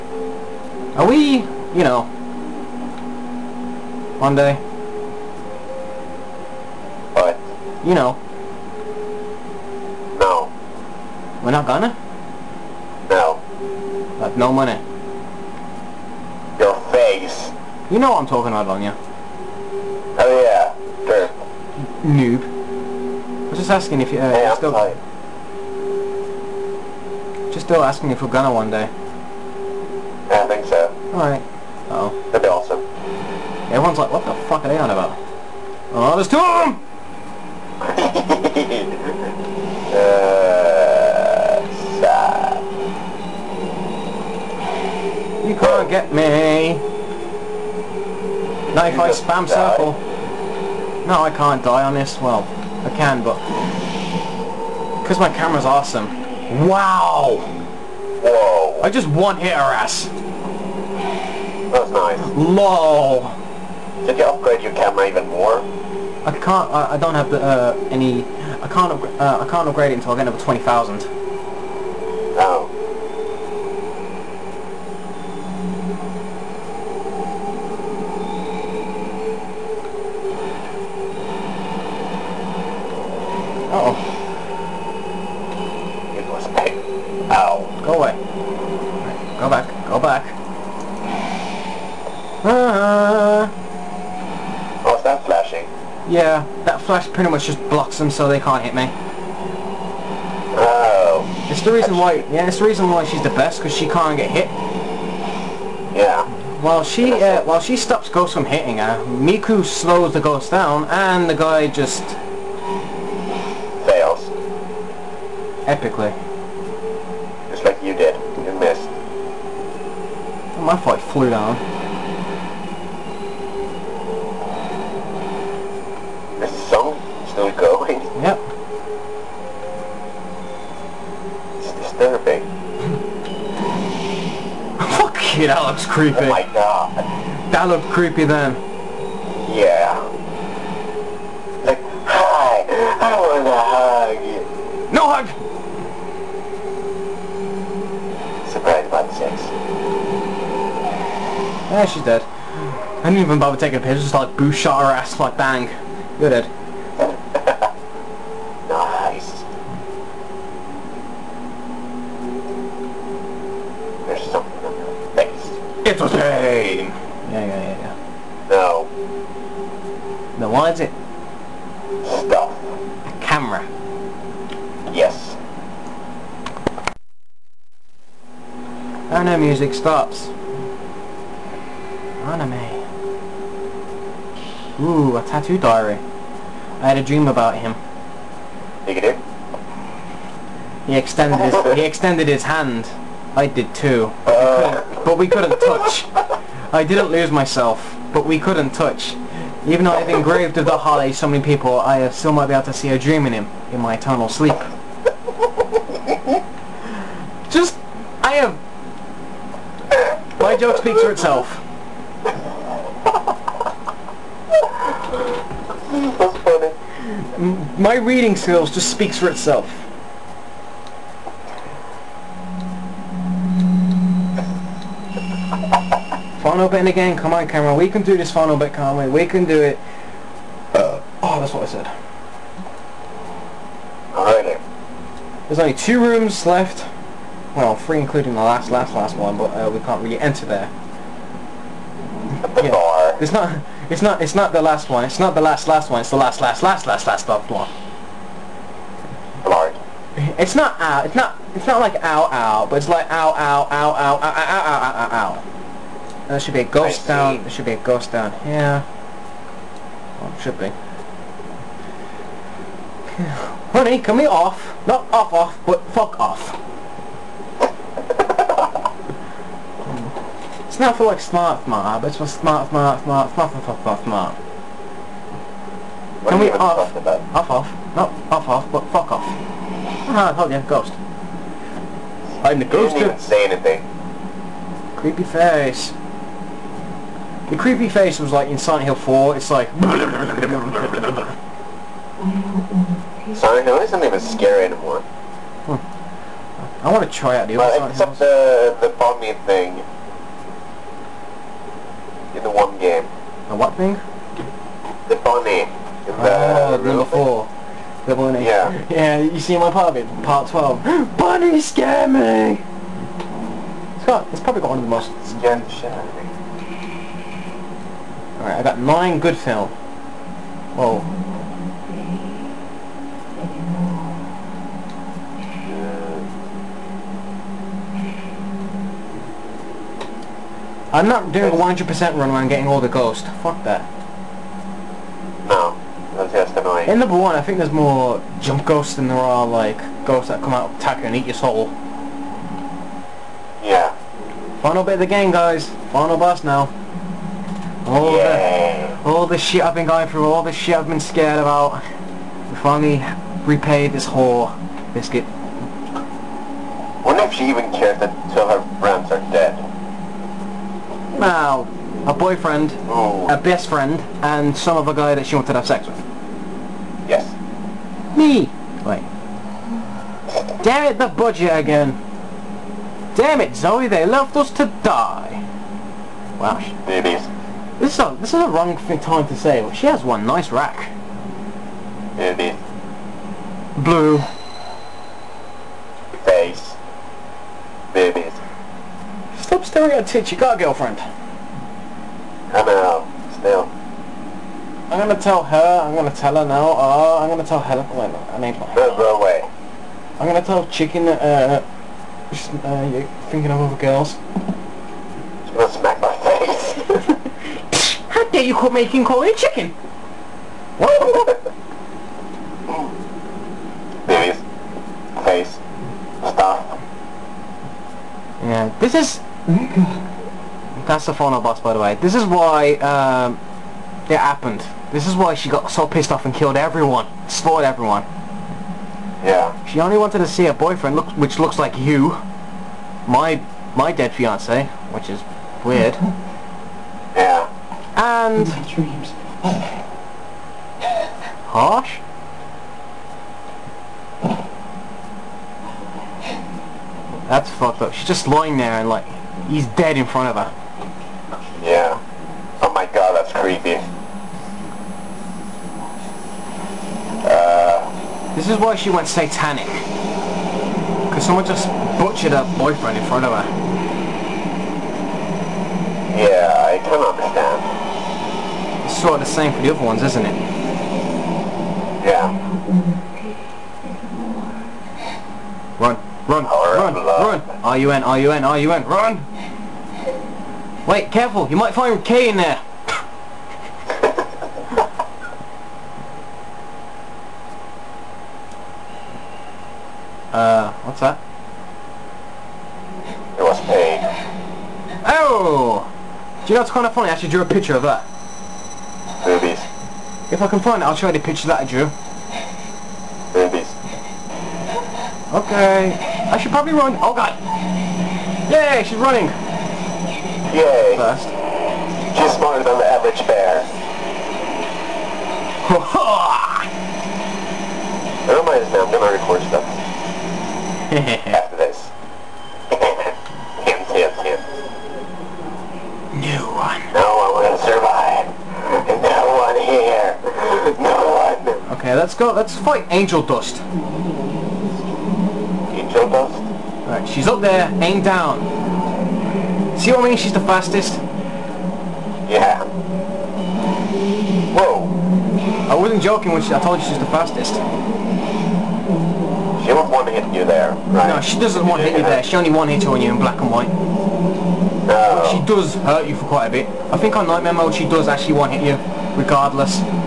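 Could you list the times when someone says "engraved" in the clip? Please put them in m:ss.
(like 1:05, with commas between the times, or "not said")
3:20.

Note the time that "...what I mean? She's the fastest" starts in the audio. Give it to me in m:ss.
8:59.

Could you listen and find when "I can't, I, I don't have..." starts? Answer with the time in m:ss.
1:06.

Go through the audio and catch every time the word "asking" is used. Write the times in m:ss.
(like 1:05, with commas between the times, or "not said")
0:23, 0:27.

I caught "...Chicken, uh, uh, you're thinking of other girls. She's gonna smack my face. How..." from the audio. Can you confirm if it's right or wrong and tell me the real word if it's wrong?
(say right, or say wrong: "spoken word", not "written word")
right.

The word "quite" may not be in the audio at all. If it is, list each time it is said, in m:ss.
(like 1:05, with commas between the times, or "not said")
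9:16.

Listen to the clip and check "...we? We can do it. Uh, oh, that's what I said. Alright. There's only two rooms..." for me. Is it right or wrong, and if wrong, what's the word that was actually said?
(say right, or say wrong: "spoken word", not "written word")
right.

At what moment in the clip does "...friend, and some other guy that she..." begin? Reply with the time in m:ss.
6:03.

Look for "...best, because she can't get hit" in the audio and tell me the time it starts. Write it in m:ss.
1:43.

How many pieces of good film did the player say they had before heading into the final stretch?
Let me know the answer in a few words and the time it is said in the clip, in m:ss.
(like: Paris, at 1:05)
9, at 5:18.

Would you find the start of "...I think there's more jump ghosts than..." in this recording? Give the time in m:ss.
5:37.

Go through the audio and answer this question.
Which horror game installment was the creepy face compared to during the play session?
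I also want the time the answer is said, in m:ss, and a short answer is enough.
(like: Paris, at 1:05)
Silent Hill 4, at 4:48.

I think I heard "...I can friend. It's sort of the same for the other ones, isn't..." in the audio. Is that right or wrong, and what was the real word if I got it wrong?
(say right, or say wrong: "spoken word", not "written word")
wrong: "understand", not "friend".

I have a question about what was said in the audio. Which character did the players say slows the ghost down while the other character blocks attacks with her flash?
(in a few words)
Miku.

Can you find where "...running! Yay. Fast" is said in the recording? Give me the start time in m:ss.
8:28.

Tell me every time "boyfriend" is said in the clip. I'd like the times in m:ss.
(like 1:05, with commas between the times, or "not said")
6:02, 7:10, 7:42.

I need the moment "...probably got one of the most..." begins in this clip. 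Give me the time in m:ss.
5:14.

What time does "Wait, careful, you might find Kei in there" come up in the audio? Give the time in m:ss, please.
8:00.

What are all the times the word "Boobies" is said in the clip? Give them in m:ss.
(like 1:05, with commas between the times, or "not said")
8:19, 8:23.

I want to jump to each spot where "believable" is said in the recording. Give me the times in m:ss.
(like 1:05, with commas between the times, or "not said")
not said.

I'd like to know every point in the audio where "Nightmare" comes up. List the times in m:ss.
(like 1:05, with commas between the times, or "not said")
9:17.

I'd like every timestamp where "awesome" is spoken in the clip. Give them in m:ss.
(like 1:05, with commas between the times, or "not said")
0:32, 0:55.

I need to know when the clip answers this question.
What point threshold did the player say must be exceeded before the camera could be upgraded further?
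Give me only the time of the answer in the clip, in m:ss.
1:10.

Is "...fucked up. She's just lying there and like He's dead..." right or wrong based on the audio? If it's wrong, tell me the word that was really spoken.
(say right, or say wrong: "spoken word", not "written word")
right.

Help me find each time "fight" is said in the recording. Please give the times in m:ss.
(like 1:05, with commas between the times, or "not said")
2:00, 8:52.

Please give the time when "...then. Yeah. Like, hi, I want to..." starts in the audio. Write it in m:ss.
2:18.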